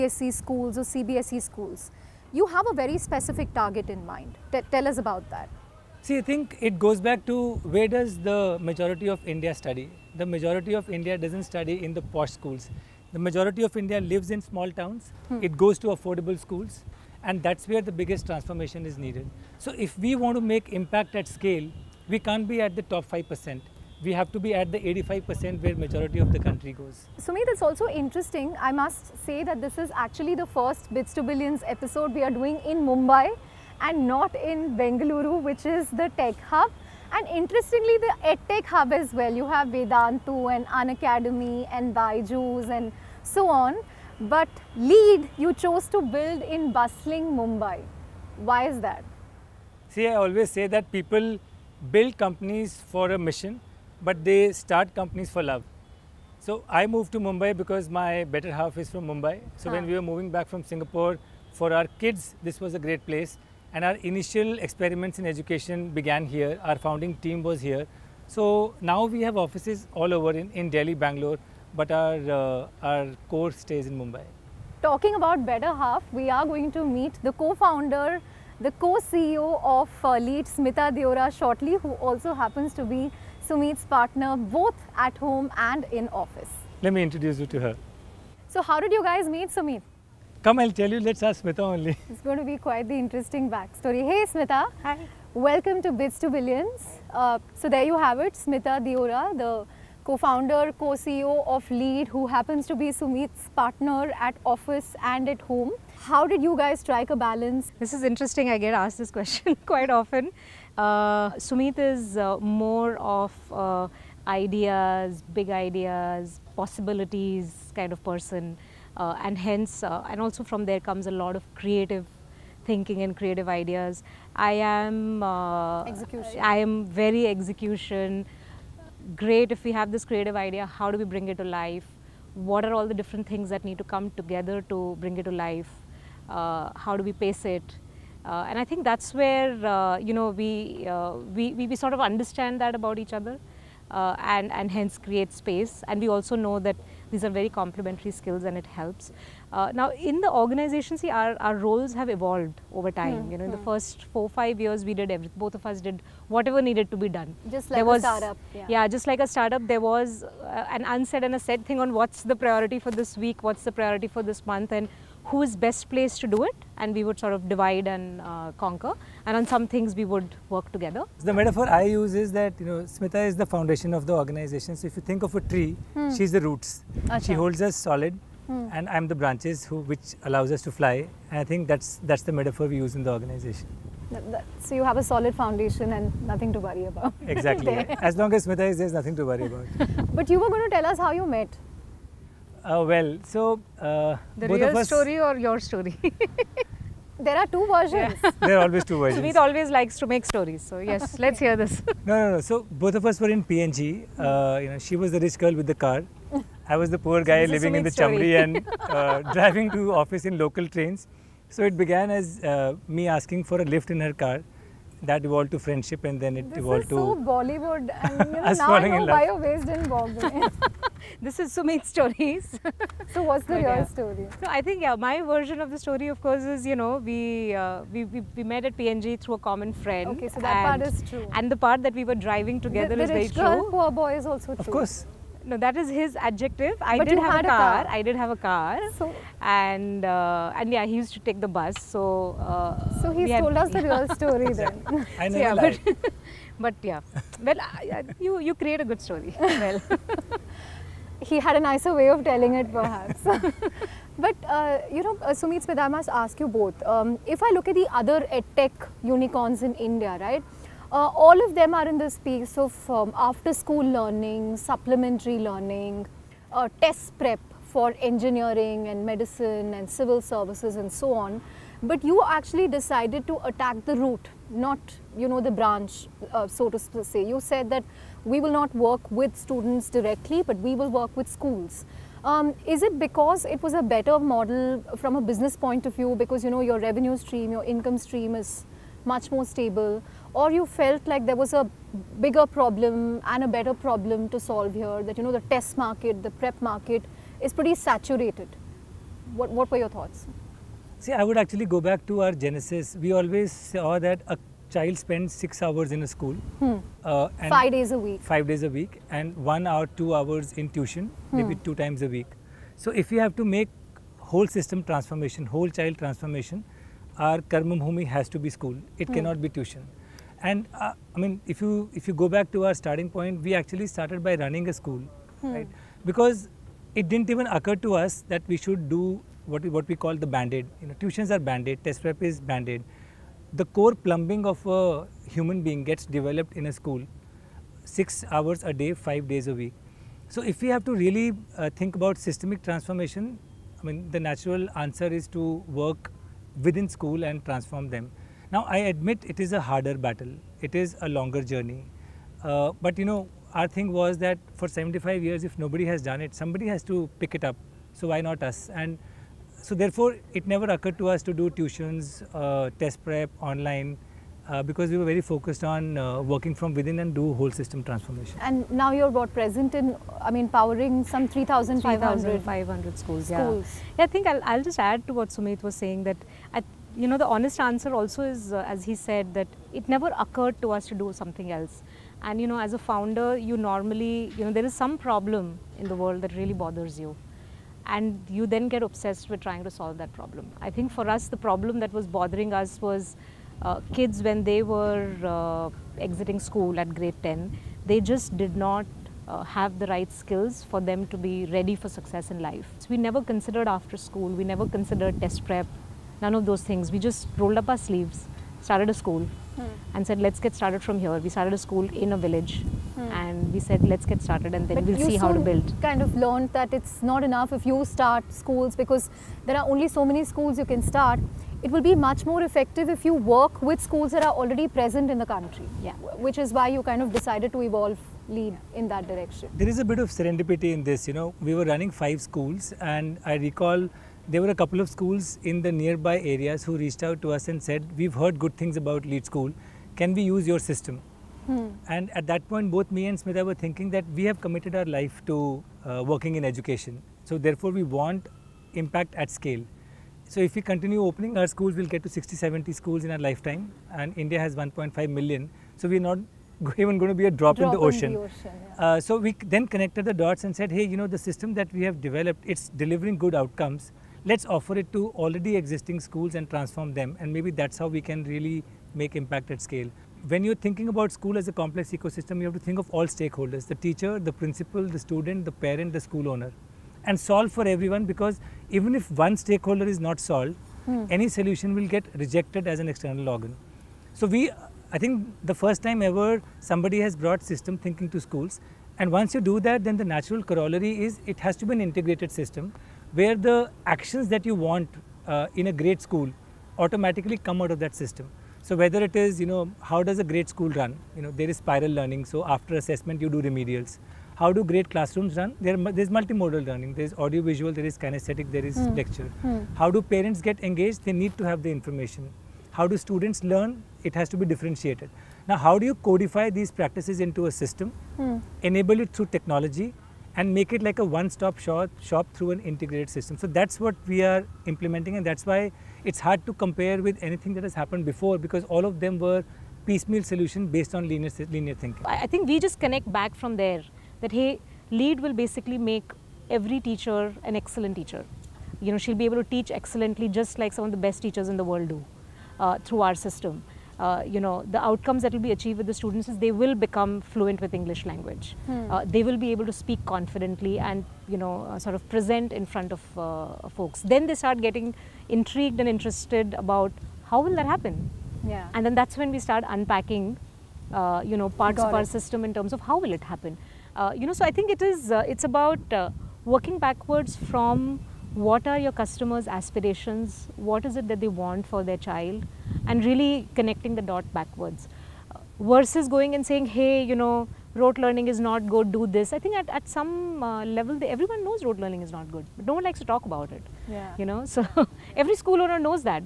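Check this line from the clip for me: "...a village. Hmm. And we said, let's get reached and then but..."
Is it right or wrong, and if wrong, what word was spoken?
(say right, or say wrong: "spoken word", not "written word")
wrong: "started", not "reached".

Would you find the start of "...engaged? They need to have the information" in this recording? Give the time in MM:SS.
08:30.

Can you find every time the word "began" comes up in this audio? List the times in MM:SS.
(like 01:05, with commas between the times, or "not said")
01:05, 03:31.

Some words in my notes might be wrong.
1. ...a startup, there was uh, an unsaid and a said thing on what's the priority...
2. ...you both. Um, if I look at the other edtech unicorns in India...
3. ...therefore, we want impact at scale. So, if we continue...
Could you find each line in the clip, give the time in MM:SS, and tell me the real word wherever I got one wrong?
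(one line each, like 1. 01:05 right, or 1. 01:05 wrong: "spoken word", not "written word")
1. 02:39 right
2. 04:16 right
3. 07:27 right.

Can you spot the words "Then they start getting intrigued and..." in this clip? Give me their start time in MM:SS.
09:14.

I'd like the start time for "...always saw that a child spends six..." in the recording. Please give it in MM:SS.
05:03.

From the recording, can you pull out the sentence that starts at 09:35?
versus going and saying, hey, you know, rote learning is not good, do this.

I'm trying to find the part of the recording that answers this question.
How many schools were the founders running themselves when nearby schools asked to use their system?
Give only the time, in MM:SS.
07:11.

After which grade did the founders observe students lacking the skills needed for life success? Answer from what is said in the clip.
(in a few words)
Grade 10.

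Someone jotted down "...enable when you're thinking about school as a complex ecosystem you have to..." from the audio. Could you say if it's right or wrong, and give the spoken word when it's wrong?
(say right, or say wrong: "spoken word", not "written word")
wrong: "scale", not "enable".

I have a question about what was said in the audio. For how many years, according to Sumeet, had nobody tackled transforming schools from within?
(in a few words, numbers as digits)
75.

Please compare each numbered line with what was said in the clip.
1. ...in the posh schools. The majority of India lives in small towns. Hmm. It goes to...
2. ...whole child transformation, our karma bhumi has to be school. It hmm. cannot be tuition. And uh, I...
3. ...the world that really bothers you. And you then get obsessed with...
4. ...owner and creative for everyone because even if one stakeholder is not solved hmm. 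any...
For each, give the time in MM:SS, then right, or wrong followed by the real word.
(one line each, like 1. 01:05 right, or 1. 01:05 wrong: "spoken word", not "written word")
1. 00:11 right
2. 05:15 right
3. 06:25 right
4. 07:56 wrong: "solve", not "creative".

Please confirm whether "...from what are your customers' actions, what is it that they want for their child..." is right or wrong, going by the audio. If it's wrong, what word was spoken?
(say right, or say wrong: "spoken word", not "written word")
wrong: "aspirations", not "actions".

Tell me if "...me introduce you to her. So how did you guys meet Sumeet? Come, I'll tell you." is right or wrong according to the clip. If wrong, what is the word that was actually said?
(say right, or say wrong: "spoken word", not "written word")
right.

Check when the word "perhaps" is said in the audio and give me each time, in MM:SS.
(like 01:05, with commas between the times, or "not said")
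04:12.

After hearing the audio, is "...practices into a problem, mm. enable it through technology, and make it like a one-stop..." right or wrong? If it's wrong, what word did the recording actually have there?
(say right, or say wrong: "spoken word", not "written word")
wrong: "system", not "problem".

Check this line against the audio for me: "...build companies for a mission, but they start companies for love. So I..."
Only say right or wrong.
right.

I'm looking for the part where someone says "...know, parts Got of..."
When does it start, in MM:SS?
09:21.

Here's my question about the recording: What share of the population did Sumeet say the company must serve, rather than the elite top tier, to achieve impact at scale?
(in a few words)
85%.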